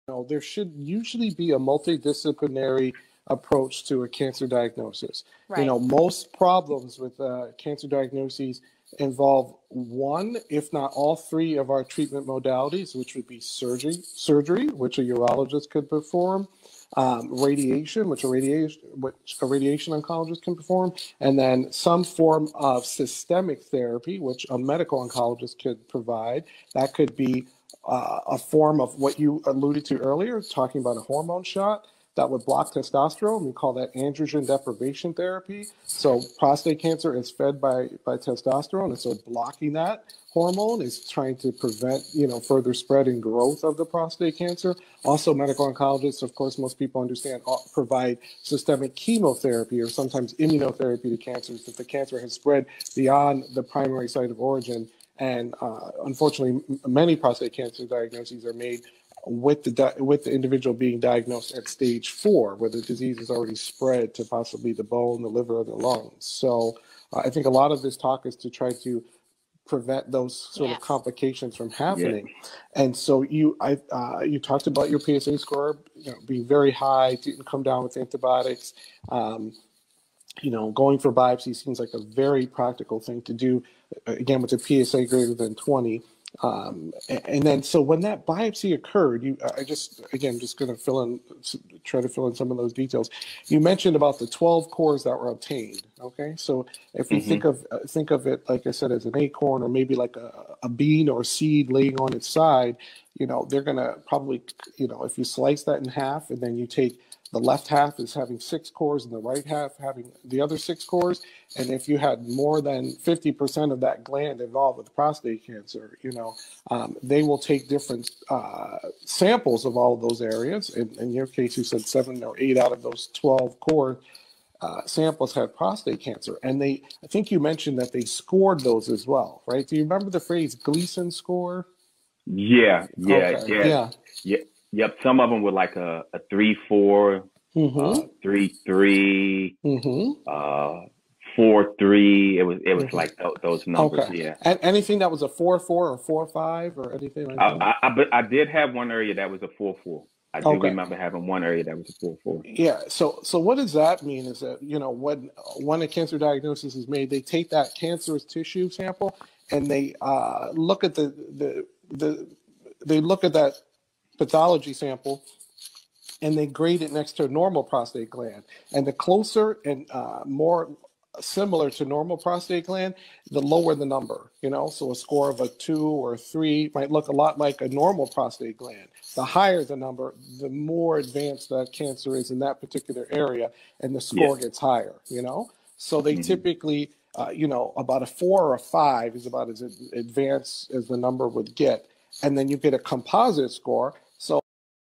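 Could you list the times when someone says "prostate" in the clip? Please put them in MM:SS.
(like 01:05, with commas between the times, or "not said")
00:36, 00:43, 00:57, 01:54, 02:05, 02:47, 02:52, 02:58.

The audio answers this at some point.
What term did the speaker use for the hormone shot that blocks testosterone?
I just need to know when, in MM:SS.
00:33.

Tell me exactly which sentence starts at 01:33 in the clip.
You mentioned about the 12 cores that were obtained.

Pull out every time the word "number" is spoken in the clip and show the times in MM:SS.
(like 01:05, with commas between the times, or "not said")
02:23, 02:53, 02:59, 03:10.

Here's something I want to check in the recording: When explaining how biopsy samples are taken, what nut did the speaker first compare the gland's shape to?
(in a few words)
acorn.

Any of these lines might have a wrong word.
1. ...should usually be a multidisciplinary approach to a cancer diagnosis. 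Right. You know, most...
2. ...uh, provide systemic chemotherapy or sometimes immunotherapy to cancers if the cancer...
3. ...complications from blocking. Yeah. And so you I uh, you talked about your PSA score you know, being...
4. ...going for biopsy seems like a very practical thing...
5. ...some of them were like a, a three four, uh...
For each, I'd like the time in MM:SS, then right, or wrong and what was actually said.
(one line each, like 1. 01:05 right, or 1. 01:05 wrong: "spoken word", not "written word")
1. 00:00 right
2. 00:47 right
3. 01:10 wrong: "happening", not "blocking"
4. 01:20 right
5. 02:15 right.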